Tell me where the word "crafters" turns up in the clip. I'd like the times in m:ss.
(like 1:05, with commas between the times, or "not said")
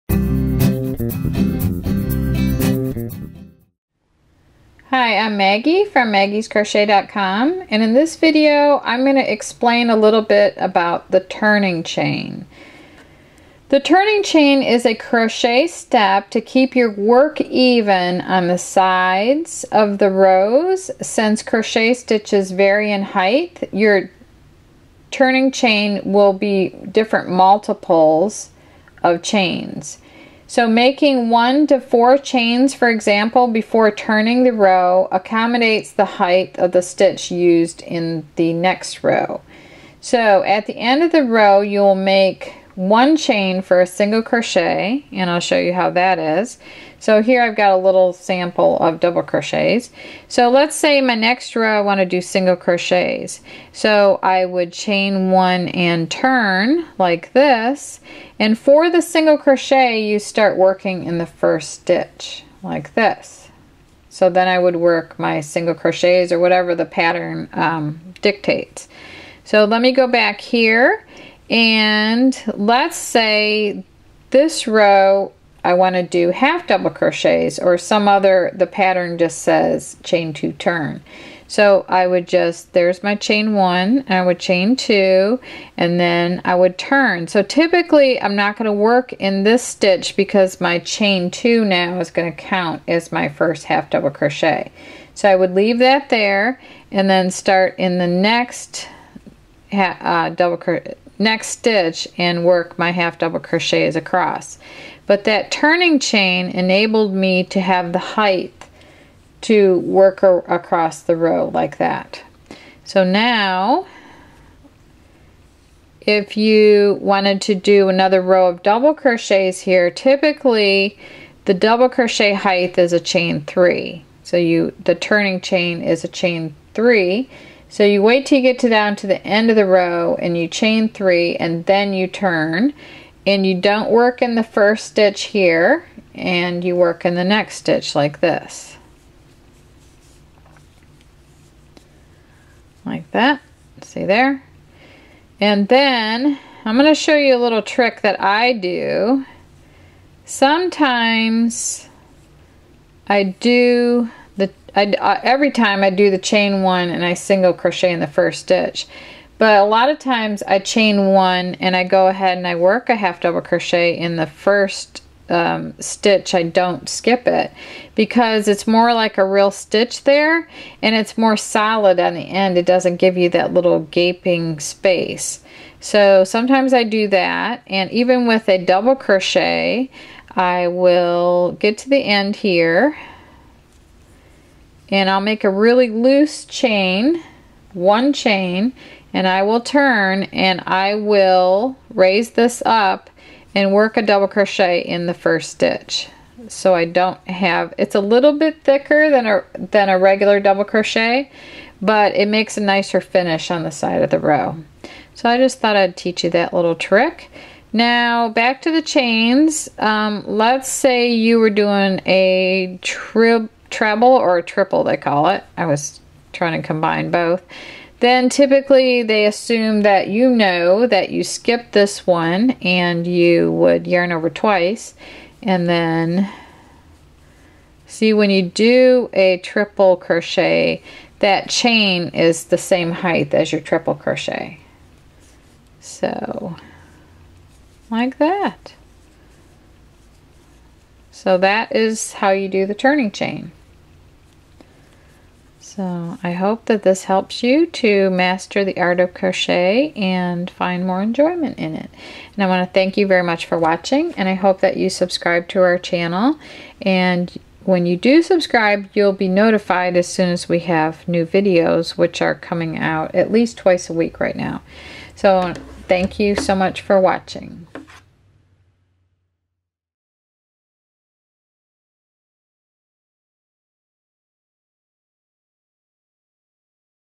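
not said.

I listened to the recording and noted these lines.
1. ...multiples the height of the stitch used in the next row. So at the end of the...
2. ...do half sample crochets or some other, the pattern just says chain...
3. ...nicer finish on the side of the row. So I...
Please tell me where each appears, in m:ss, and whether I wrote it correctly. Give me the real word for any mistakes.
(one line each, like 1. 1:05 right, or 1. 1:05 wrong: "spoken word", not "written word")
1. 0:35 wrong: "accommodates", not "multiples"
2. 1:16 wrong: "double", not "sample"
3. 3:22 right.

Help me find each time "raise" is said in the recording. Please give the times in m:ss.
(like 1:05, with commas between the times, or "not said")
3:11.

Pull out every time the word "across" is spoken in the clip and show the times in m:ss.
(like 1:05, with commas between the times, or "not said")
1:43, 1:50.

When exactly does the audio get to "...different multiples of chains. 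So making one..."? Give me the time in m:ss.
0:26.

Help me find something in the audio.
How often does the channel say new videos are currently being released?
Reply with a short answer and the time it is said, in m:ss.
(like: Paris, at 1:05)
twice a week, at 4:23.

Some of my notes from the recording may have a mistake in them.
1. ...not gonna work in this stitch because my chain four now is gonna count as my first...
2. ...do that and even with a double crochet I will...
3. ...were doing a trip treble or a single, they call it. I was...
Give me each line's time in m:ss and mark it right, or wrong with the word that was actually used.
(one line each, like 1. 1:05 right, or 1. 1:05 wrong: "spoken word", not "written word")
1. 1:28 wrong: "two", not "four"
2. 2:56 right
3. 3:31 wrong: "triple", not "single".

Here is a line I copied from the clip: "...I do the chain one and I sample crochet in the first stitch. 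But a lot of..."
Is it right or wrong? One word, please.
wrong.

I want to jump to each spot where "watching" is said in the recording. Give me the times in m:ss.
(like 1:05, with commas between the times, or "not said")
4:13, 4:26.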